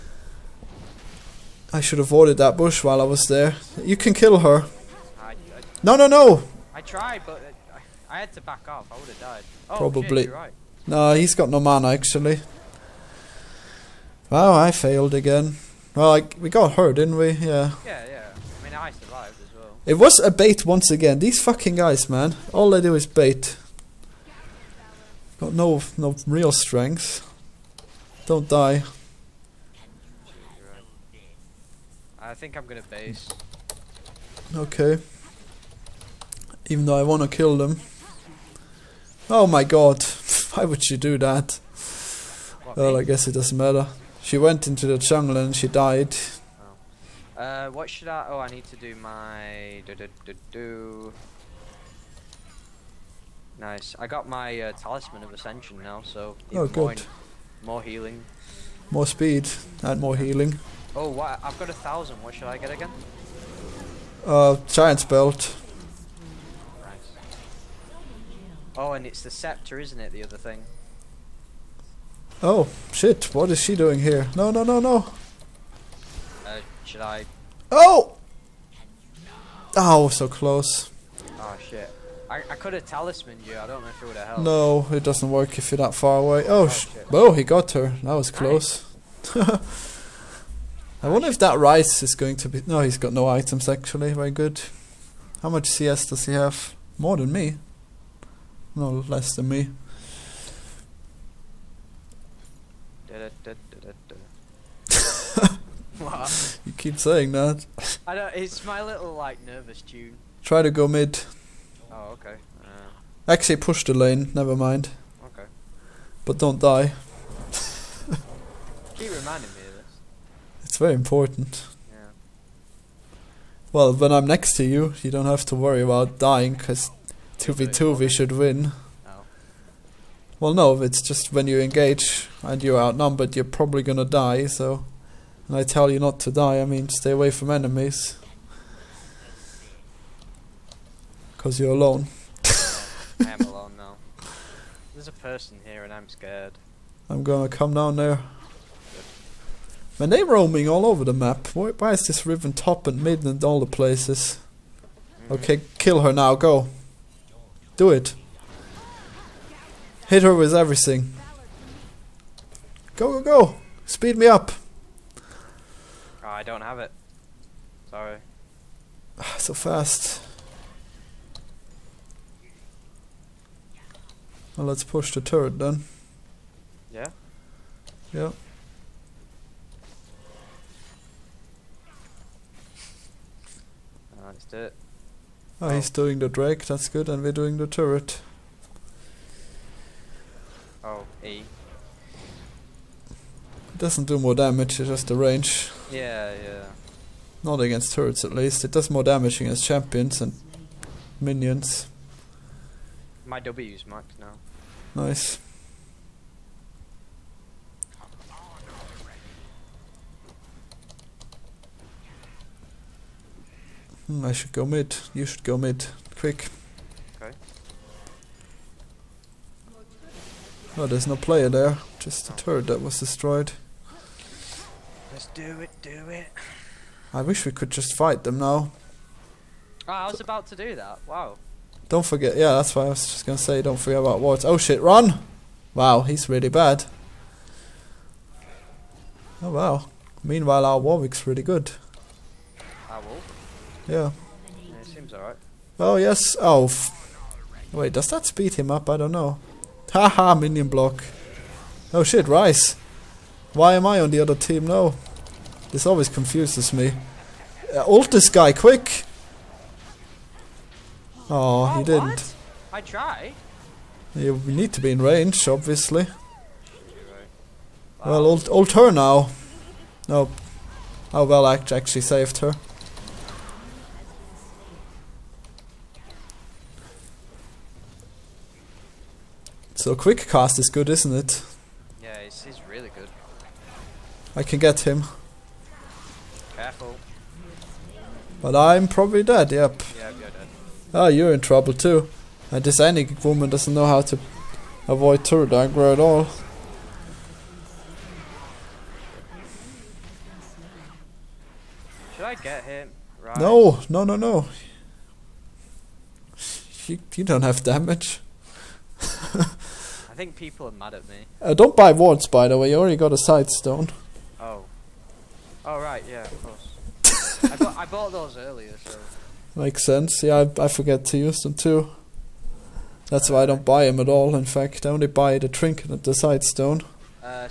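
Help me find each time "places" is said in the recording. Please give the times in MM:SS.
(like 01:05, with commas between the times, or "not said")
02:33.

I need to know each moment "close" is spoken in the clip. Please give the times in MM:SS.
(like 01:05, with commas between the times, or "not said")
01:20, 01:28.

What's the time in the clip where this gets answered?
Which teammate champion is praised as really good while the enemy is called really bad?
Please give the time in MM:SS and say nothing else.
04:00.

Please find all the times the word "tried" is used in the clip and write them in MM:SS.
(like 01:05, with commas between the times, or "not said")
00:06, 04:22.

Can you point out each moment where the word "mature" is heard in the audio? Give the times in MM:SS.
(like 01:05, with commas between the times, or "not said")
not said.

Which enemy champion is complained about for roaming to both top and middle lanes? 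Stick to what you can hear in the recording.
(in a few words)
Riven.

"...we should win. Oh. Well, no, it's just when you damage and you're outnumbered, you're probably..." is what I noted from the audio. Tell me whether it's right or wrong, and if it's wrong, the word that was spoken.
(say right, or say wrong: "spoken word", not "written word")
wrong: "engage", not "damage".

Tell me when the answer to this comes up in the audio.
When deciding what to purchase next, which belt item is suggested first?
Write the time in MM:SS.
01:04.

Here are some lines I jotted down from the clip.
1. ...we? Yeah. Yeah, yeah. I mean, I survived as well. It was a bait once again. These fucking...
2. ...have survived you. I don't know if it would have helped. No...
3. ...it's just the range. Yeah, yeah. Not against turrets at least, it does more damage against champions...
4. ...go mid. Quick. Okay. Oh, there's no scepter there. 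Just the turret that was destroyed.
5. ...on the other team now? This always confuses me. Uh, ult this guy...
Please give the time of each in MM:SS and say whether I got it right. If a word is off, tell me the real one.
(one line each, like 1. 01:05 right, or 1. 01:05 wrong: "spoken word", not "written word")
1. 00:17 right
2. 01:22 wrong: "talismaned", not "survived"
3. 03:14 right
4. 03:35 wrong: "player", not "scepter"
5. 04:13 right.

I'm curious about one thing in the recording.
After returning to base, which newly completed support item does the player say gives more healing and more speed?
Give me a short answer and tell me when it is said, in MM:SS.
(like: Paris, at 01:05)
Talisman of Ascension, at 00:54.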